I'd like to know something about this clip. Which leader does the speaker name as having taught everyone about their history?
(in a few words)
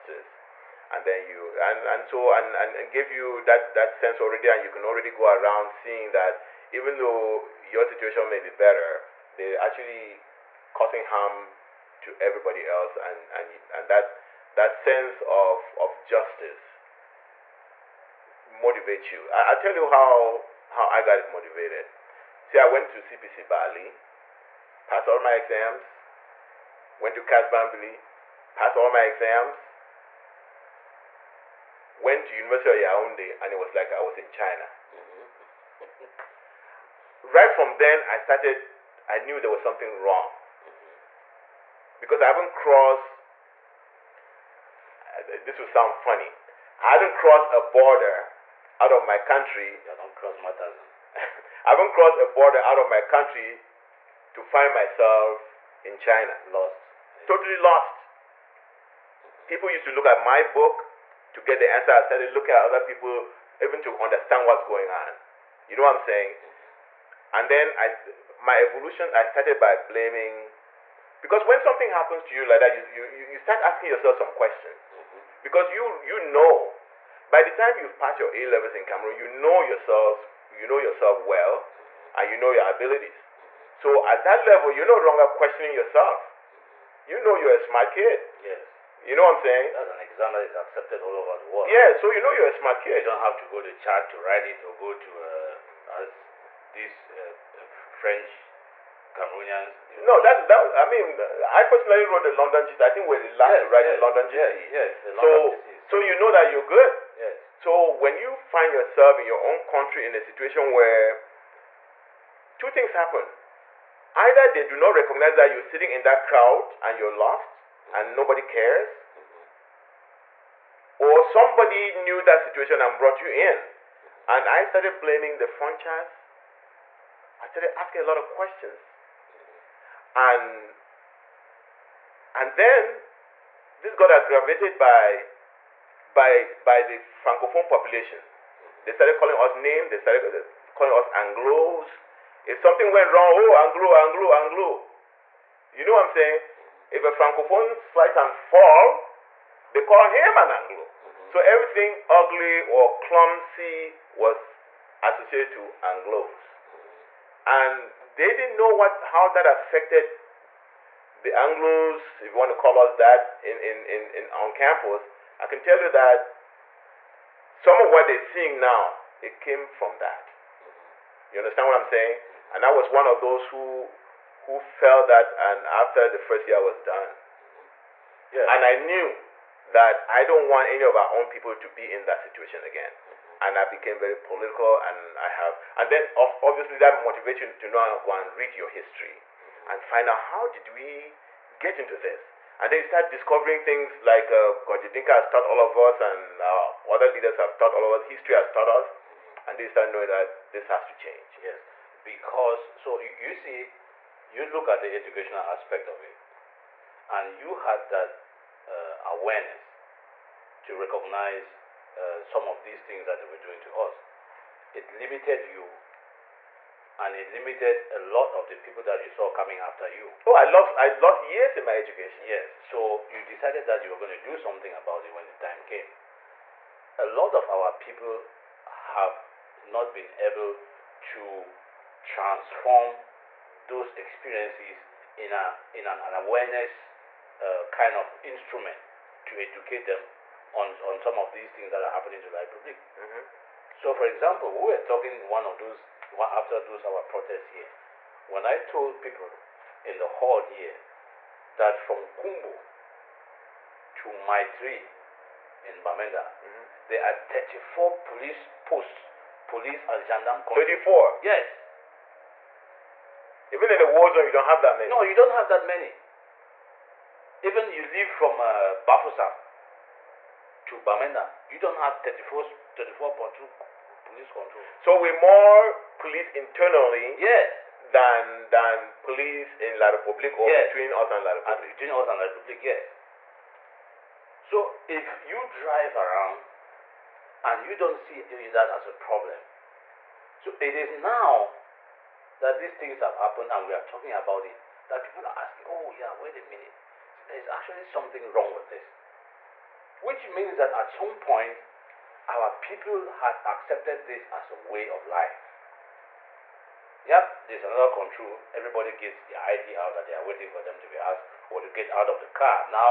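Gorji Dinka.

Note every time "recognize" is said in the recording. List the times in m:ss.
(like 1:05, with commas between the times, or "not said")
1:54, 3:30.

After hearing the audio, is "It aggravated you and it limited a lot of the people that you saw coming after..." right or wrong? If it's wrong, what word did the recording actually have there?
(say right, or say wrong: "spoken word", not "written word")
wrong: "limited", not "aggravated".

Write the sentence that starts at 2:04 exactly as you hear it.
and I started blaming the franchise I started asking a lot of questions.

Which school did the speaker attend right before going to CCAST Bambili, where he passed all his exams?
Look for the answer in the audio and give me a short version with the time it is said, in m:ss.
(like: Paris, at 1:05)
CPC Bali, at 0:22.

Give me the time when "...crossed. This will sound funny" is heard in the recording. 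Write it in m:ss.
0:42.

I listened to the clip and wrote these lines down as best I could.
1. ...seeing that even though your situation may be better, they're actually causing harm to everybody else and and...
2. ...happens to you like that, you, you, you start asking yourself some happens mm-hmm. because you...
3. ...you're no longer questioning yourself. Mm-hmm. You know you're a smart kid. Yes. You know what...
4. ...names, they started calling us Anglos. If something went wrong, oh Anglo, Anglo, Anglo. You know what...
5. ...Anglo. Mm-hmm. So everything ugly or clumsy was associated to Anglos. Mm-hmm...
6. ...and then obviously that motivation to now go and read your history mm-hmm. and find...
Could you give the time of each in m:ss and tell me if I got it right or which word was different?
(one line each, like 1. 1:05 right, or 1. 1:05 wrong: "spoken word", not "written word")
1. 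0:05 right
2. 1:11 wrong: "questions", not "happens"
3. 1:24 right
4. 2:19 right
5. 2:30 right
6. 3:05 right.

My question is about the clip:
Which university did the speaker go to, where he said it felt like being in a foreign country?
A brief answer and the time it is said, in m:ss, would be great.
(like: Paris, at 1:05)
University of Yaounde, at 0:32.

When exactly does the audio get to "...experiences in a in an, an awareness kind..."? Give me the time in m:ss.
3:53.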